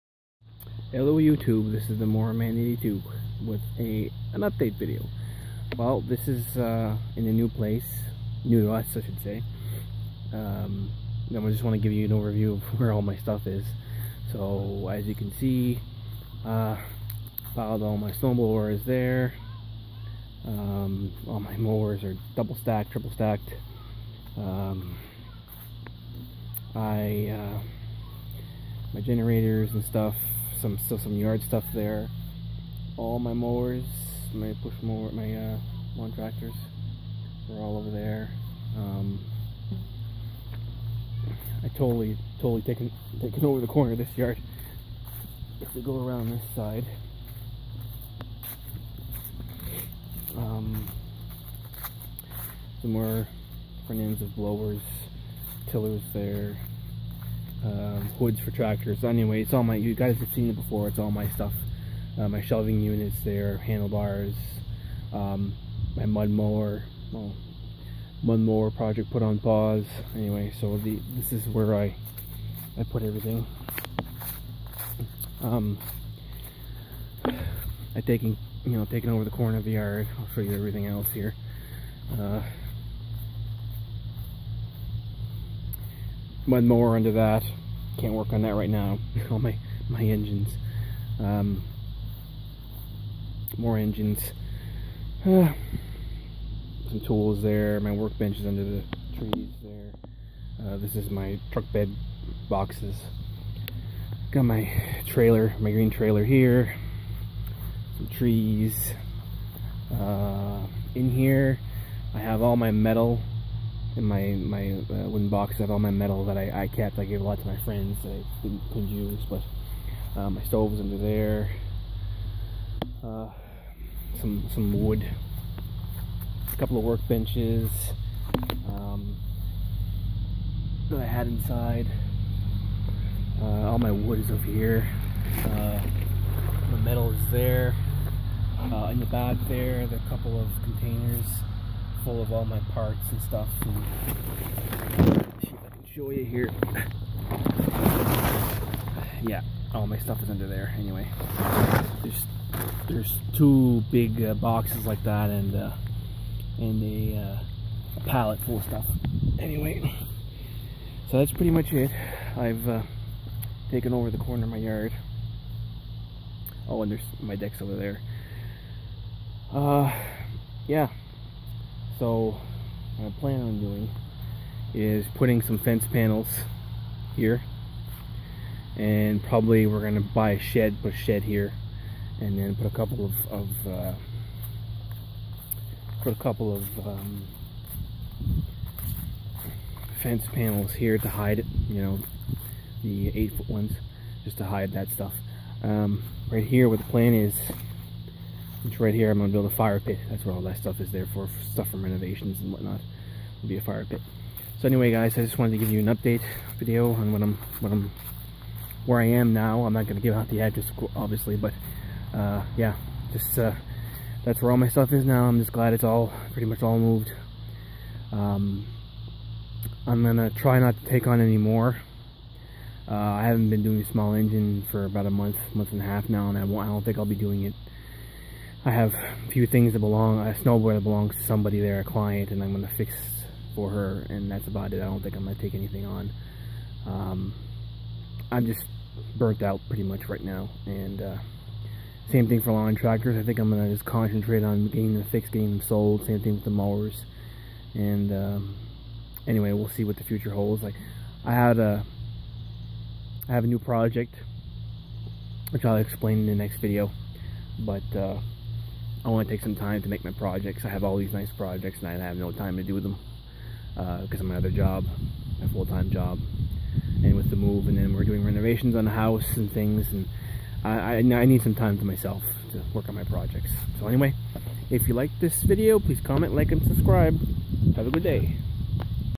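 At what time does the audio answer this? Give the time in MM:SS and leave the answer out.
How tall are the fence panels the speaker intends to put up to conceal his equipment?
03:13.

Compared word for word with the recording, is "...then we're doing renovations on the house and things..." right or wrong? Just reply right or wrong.
right.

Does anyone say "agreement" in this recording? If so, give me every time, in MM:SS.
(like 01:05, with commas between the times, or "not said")
not said.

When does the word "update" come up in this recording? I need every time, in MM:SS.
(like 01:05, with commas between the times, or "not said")
00:04, 03:25.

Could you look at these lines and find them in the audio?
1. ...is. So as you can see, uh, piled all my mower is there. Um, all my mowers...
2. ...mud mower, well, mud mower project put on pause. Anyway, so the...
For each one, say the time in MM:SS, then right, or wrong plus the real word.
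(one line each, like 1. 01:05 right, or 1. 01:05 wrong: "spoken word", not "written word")
1. 00:13 wrong: "snowblower", not "mower"
2. 01:06 right.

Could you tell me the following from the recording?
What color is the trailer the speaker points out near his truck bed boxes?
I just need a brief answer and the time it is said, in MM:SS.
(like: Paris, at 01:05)
green, at 01:45.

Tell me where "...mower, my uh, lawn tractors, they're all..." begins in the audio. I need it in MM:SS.
00:34.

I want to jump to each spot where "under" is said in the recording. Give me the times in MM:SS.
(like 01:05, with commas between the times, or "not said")
01:26, 01:38, 02:00, 02:30.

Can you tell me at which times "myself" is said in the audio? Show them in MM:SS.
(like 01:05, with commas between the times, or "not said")
04:31.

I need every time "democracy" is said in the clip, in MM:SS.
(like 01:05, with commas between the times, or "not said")
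not said.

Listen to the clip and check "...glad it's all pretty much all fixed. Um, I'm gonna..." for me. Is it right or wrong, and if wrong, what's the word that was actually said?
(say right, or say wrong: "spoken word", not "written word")
wrong: "moved", not "fixed".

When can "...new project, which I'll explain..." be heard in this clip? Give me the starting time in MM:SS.
04:13.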